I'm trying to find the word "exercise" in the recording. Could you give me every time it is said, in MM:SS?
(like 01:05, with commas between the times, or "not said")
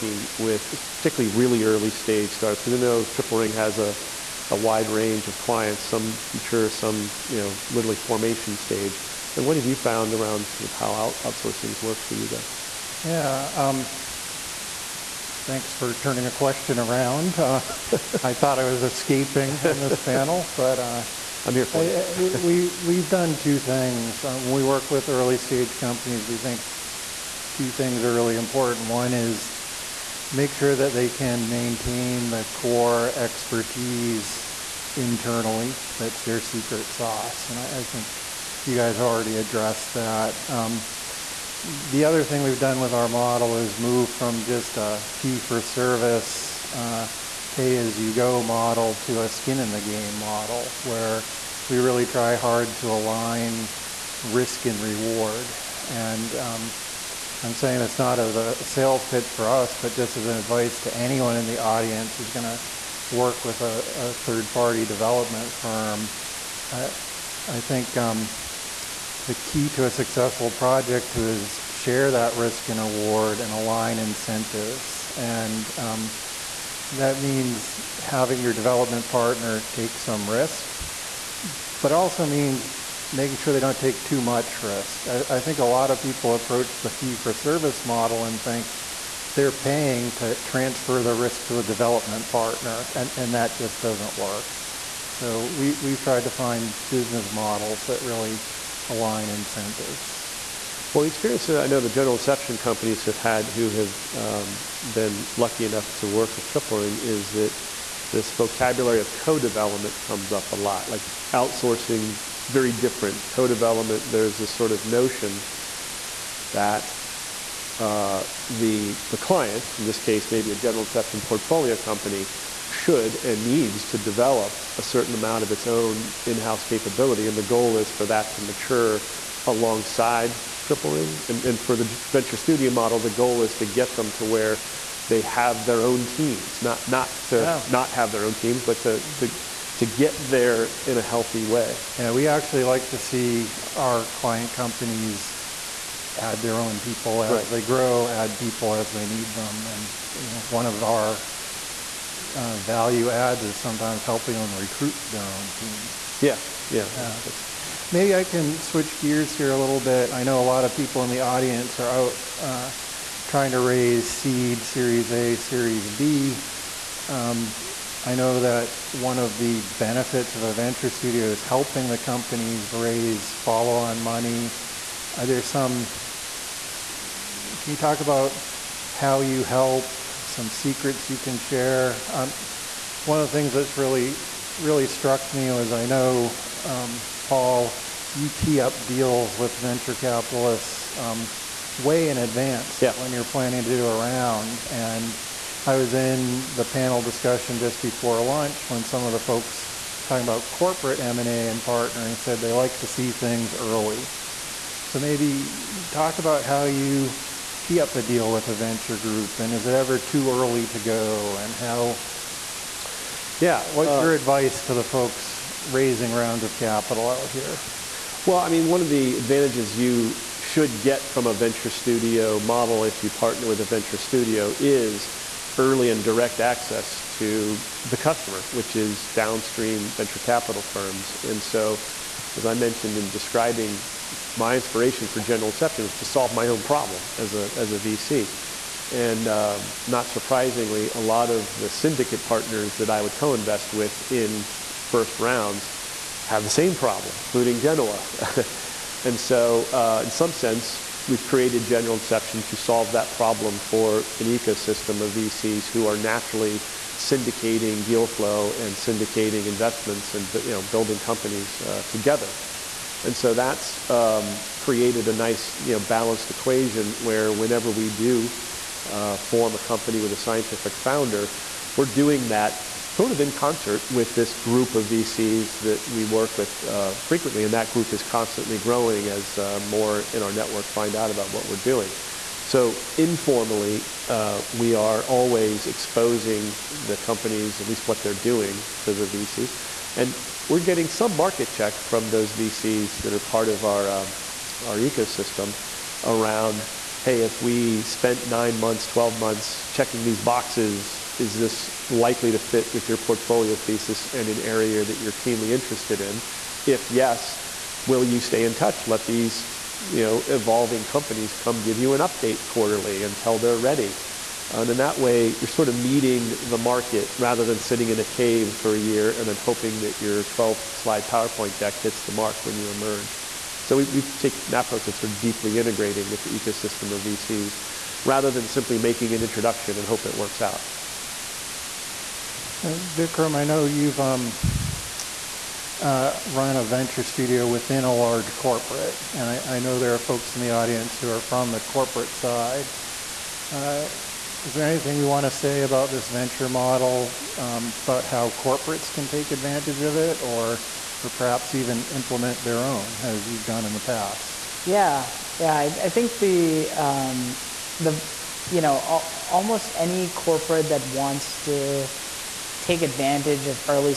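not said.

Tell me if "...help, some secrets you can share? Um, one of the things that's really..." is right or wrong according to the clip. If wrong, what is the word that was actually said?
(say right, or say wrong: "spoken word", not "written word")
right.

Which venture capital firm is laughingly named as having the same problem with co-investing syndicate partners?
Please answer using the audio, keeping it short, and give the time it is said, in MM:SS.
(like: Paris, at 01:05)
Genoa, at 04:07.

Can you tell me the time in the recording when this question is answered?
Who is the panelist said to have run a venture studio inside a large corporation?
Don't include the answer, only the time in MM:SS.
05:32.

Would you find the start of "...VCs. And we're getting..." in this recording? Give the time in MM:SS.
04:49.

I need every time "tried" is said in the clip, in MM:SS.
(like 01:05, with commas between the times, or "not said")
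01:35.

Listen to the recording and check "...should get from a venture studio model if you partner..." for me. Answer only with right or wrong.
right.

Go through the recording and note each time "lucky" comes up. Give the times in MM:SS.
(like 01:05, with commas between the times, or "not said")
01:45.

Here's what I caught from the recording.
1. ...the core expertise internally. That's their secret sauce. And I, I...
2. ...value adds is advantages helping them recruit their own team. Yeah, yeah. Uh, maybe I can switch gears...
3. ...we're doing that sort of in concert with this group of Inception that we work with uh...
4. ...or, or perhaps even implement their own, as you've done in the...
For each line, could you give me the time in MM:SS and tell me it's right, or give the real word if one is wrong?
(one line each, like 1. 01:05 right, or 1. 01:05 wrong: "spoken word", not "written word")
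1. 00:32 right
2. 02:32 wrong: "sometimes", not "advantages"
3. 04:31 wrong: "VCs", not "Inception"
4. 05:50 right.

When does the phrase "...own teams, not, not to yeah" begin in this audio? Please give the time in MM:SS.
02:15.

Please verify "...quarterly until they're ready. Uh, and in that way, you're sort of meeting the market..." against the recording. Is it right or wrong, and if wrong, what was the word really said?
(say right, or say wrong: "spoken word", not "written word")
right.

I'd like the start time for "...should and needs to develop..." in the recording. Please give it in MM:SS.
02:02.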